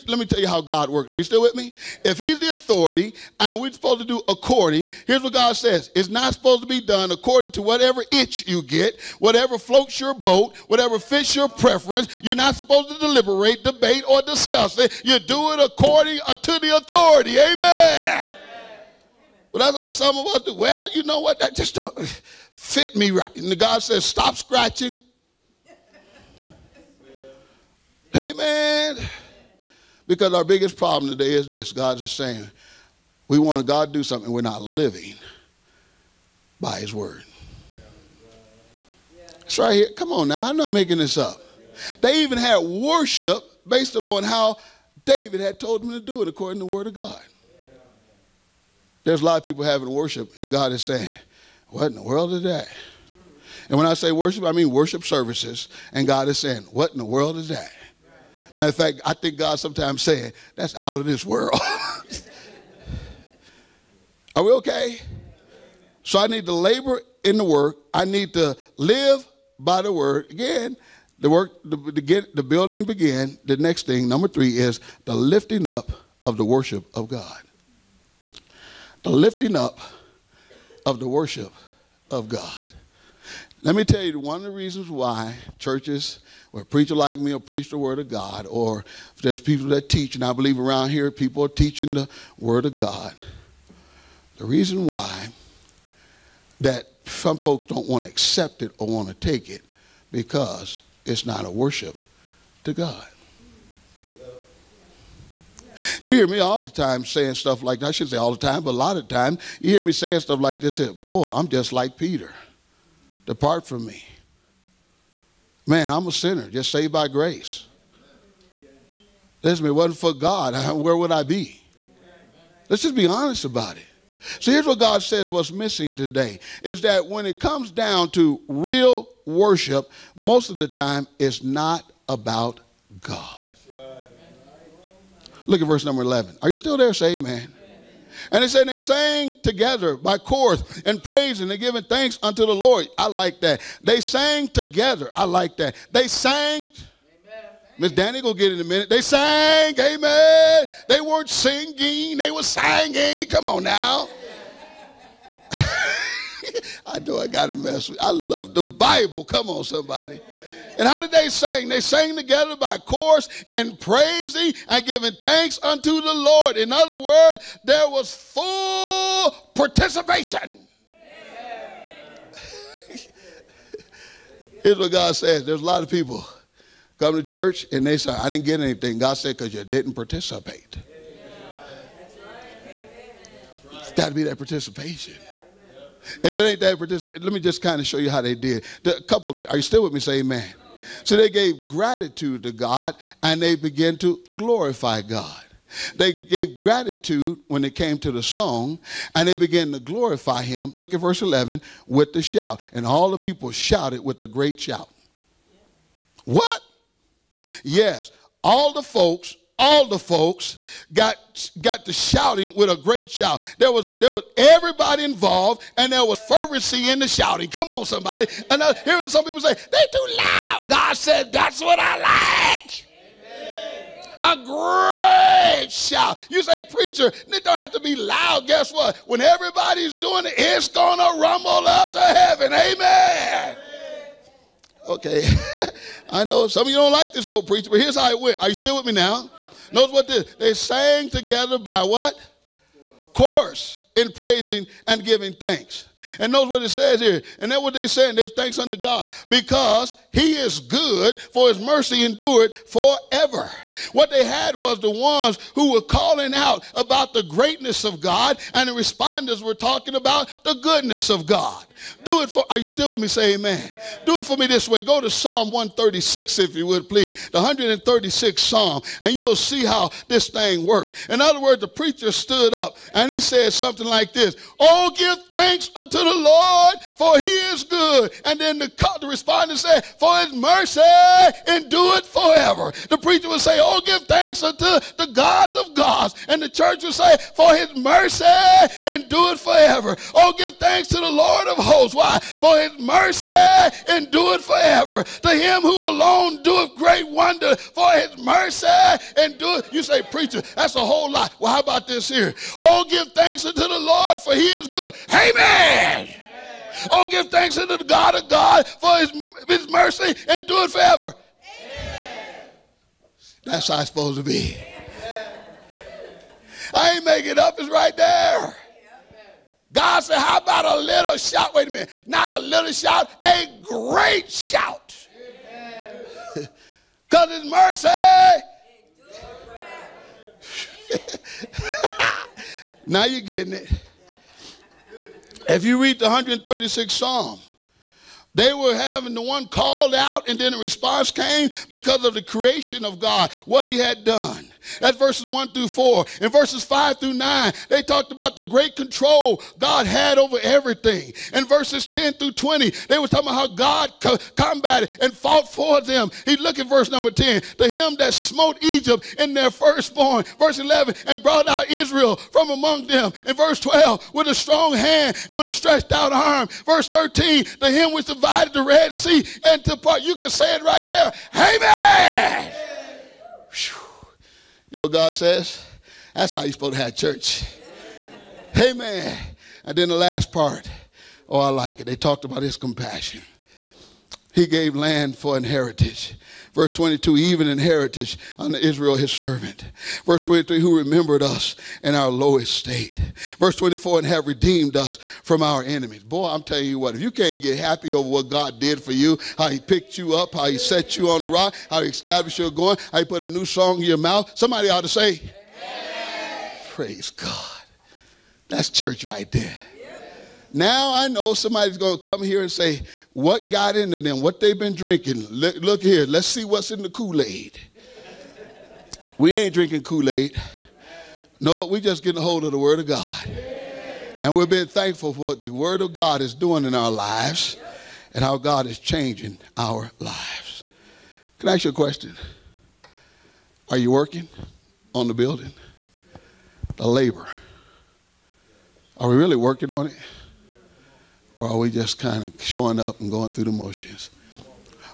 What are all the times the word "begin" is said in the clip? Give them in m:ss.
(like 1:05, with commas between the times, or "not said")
1:12.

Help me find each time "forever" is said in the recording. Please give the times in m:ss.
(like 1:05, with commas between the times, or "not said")
4:12, 4:42, 4:49, 4:54, 5:10.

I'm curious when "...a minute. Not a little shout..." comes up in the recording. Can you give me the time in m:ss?
5:21.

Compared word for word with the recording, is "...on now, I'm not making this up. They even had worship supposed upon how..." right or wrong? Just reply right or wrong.
wrong.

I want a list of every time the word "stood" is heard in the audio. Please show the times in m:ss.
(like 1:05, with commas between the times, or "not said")
4:32.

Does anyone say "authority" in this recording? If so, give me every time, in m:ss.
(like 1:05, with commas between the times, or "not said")
0:02, 0:16.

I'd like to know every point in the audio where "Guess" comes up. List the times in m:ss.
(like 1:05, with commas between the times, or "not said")
3:48.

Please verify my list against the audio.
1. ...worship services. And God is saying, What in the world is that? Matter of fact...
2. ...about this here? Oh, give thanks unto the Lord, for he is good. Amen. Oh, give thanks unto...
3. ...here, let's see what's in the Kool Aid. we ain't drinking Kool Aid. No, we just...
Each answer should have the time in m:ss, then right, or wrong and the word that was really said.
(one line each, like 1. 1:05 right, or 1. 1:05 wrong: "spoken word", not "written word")
1. 0:54 right
2. 5:01 right
3. 6:55 right.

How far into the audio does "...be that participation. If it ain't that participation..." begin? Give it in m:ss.
3:04.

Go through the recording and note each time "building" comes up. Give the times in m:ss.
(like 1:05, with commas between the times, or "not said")
1:12, 7:15.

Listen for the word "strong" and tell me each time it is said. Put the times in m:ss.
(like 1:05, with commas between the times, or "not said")
6:04.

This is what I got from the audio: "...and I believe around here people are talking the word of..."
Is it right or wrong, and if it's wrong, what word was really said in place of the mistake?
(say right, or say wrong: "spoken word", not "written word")
wrong: "teaching", not "talking".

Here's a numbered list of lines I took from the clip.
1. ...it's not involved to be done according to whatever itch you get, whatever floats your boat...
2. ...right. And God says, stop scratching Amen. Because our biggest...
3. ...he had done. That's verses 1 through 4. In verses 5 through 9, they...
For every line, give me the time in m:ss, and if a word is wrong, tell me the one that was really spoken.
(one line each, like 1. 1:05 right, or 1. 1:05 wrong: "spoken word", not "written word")
1. 0:05 wrong: "supposed", not "involved"
2. 0:23 right
3. 5:43 right.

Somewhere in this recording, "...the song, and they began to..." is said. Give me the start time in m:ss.
3:18.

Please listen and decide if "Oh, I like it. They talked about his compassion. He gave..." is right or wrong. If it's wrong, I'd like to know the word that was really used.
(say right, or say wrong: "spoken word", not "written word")
right.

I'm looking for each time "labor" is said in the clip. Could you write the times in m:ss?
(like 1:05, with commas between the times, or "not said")
1:06, 7:16.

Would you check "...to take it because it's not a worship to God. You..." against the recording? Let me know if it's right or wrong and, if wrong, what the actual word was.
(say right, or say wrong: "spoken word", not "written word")
right.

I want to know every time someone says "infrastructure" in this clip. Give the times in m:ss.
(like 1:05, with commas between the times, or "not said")
not said.